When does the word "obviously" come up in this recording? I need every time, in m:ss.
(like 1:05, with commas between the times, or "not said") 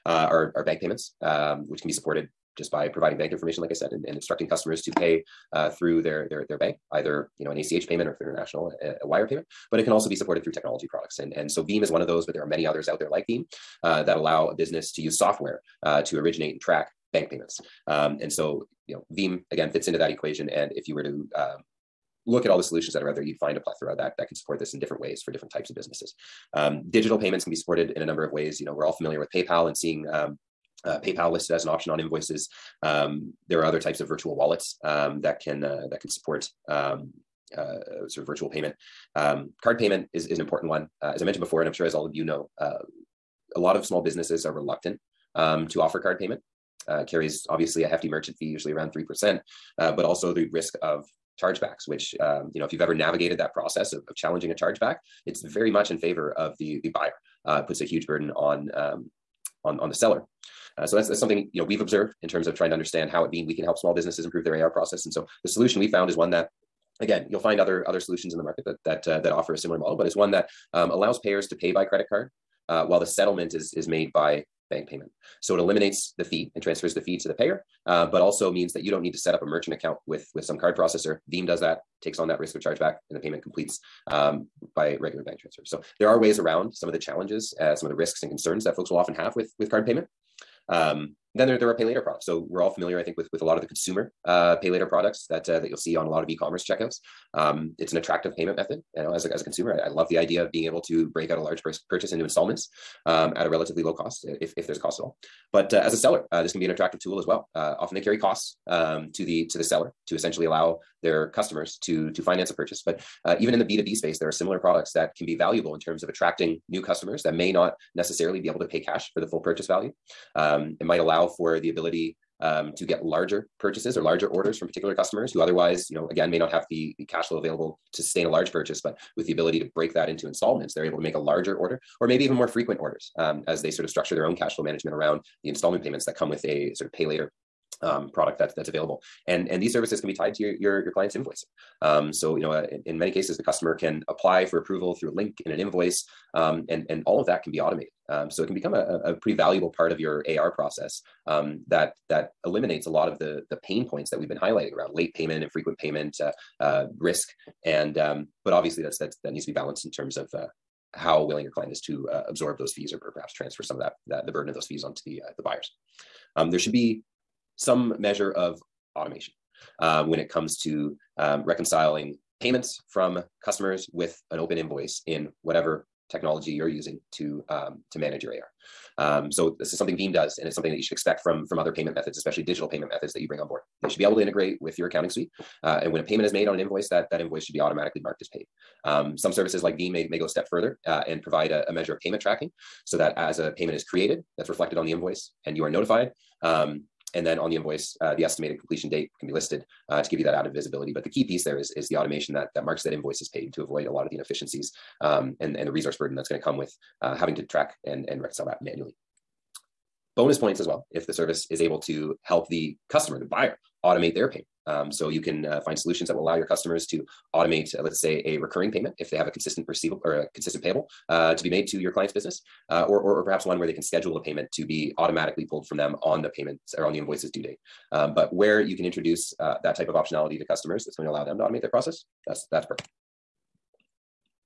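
0:47, 2:38.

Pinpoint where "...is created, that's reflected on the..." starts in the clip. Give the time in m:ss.
3:13.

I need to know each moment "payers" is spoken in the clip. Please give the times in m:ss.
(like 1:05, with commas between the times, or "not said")
1:11, 1:17.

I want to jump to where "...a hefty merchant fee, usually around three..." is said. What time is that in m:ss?
0:47.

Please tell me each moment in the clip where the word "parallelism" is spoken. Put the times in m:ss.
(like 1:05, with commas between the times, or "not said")
not said.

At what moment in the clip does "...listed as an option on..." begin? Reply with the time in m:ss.
0:31.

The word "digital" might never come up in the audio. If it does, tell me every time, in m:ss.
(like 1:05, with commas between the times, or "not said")
0:26, 3:02.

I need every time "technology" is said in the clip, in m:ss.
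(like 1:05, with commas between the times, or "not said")
0:10, 2:56.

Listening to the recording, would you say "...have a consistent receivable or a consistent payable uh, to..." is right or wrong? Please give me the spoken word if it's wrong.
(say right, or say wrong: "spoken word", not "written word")
right.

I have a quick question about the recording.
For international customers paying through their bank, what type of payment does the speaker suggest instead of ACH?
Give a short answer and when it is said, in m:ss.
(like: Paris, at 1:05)
Wire payment, at 0:09.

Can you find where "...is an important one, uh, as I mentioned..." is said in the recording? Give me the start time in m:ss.
0:40.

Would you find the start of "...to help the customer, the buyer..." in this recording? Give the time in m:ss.
3:31.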